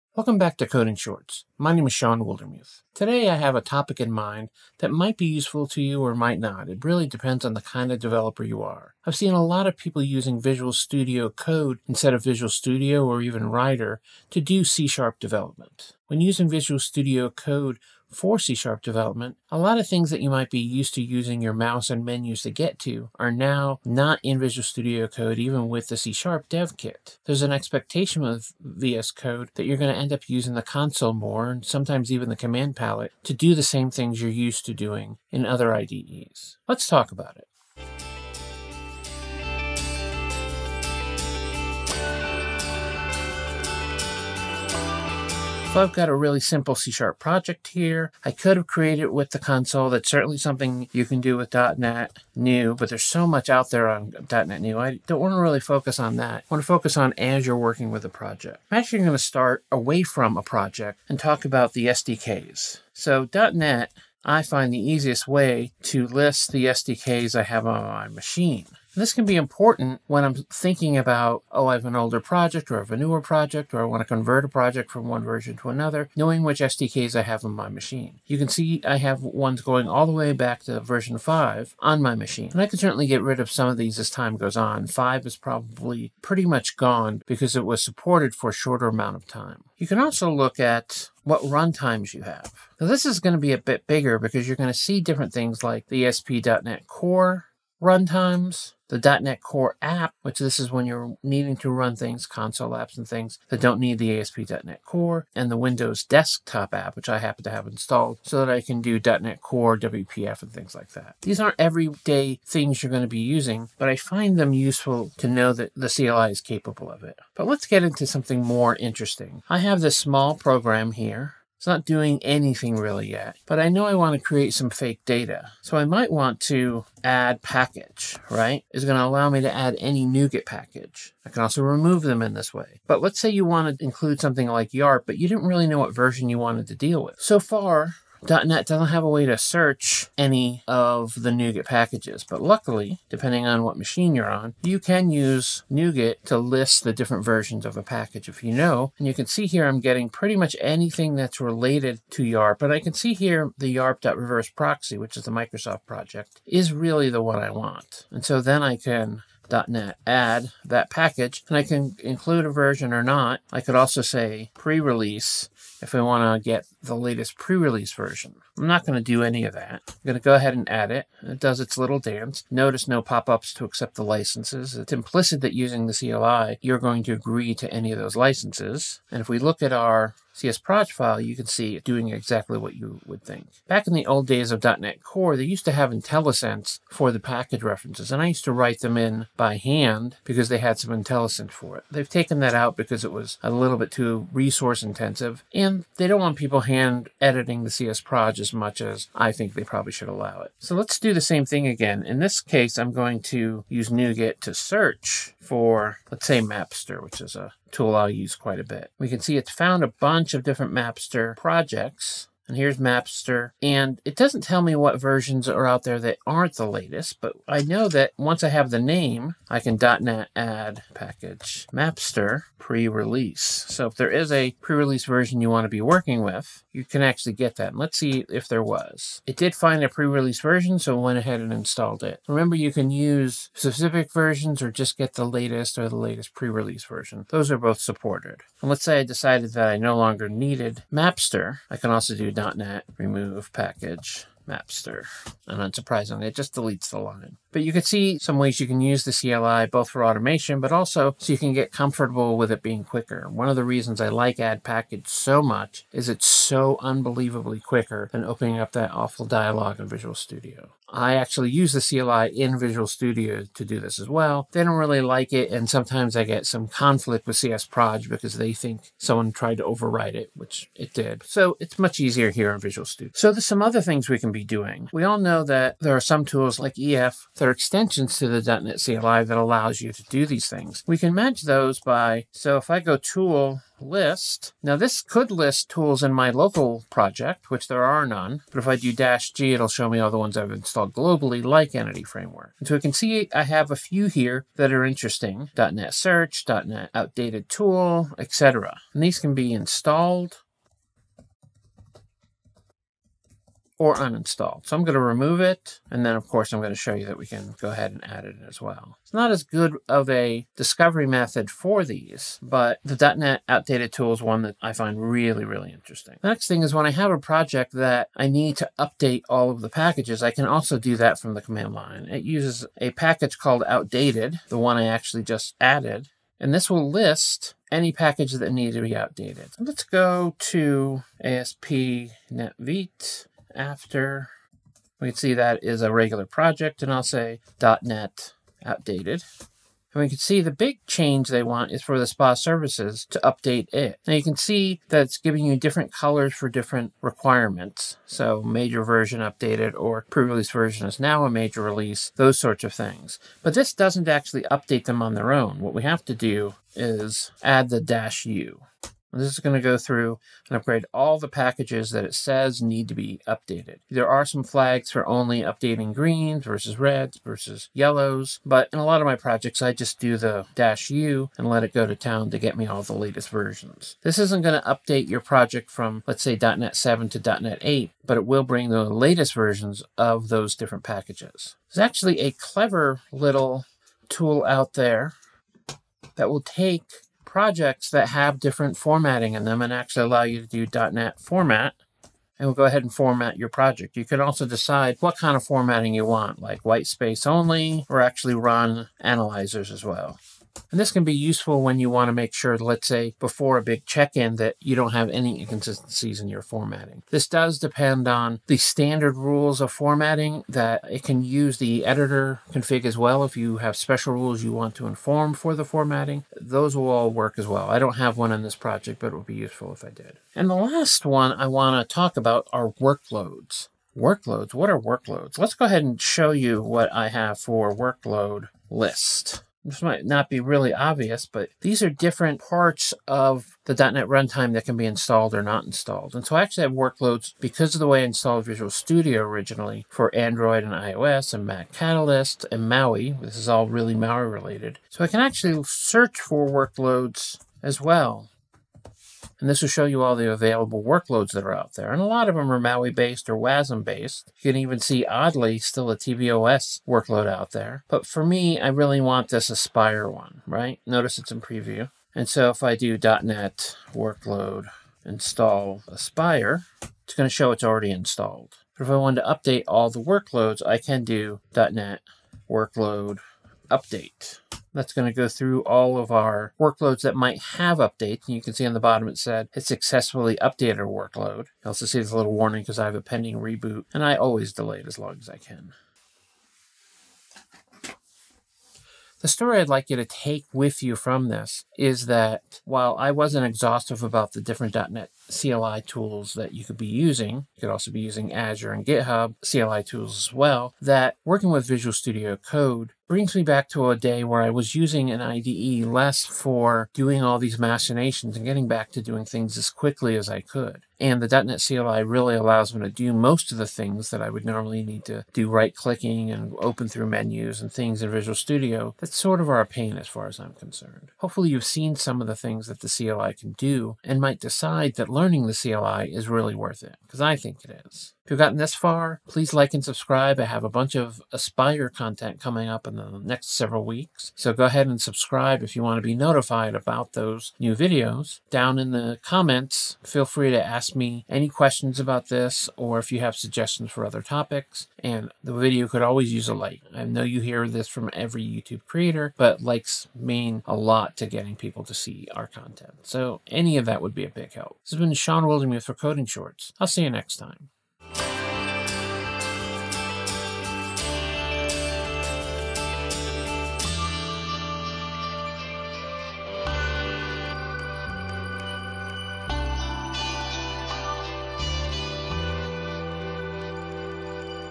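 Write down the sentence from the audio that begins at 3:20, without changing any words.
So let's do the same thing again.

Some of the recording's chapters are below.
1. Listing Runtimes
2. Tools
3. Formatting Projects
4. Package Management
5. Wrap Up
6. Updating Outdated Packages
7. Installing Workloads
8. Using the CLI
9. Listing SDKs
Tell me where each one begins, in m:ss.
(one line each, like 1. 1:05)
1. 1:29
2. 4:33
3. 6:25
4. 2:04
5. 8:05
6. 5:10
7. 7:00
8. 0:45
9. 1:04.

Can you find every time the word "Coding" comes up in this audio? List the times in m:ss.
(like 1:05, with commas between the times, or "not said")
0:00, 9:15.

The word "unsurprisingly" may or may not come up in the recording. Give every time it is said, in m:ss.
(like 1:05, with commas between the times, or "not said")
4:05.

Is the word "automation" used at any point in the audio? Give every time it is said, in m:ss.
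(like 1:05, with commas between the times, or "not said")
4:10.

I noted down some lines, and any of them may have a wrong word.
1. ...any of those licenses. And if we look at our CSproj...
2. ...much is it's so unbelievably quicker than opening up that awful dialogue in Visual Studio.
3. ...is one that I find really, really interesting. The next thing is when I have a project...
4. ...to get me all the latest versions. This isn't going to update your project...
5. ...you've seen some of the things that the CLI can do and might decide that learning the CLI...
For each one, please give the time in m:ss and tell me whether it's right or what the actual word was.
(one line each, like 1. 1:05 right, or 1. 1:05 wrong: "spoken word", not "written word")
1. 2:57 right
2. 4:15 right
3. 5:14 right
4. 6:12 right
5. 8:41 right.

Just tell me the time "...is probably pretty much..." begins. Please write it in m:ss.
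1:25.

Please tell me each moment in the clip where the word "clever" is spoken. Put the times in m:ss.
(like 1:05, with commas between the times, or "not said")
6:22.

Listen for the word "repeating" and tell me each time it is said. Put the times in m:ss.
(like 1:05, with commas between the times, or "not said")
not said.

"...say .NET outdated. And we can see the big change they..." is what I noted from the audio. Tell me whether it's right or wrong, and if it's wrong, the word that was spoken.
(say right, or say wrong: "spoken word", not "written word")
right.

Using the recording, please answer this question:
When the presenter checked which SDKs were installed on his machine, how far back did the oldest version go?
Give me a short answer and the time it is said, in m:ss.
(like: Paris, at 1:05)
5, at 1:20.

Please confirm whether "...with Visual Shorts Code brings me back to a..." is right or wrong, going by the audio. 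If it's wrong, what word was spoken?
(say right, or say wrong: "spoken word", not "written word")
wrong: "Studio", not "Shorts".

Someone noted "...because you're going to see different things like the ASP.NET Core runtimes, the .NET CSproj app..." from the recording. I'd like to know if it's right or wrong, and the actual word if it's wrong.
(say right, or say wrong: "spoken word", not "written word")
wrong: "Core", not "CSproj".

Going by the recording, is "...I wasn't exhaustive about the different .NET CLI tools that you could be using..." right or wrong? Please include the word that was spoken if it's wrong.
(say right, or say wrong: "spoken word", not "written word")
right.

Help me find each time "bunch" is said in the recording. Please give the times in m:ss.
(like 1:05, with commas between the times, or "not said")
3:29, 8:50.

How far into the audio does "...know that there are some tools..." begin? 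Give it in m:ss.
4:35.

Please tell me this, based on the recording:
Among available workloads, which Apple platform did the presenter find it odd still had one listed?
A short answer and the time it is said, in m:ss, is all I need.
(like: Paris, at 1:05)
tvOS, at 7:35.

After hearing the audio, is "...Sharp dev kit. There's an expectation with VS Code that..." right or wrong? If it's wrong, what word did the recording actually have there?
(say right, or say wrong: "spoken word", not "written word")
right.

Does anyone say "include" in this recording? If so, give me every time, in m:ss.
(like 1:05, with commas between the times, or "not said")
2:13, 2:42.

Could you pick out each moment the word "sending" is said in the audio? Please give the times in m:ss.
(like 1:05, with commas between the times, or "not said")
not said.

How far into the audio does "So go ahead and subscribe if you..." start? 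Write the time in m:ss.
8:54.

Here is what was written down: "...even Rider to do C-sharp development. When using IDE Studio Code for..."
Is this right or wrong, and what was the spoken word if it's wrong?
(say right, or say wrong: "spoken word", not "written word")
wrong: "Visual", not "IDE".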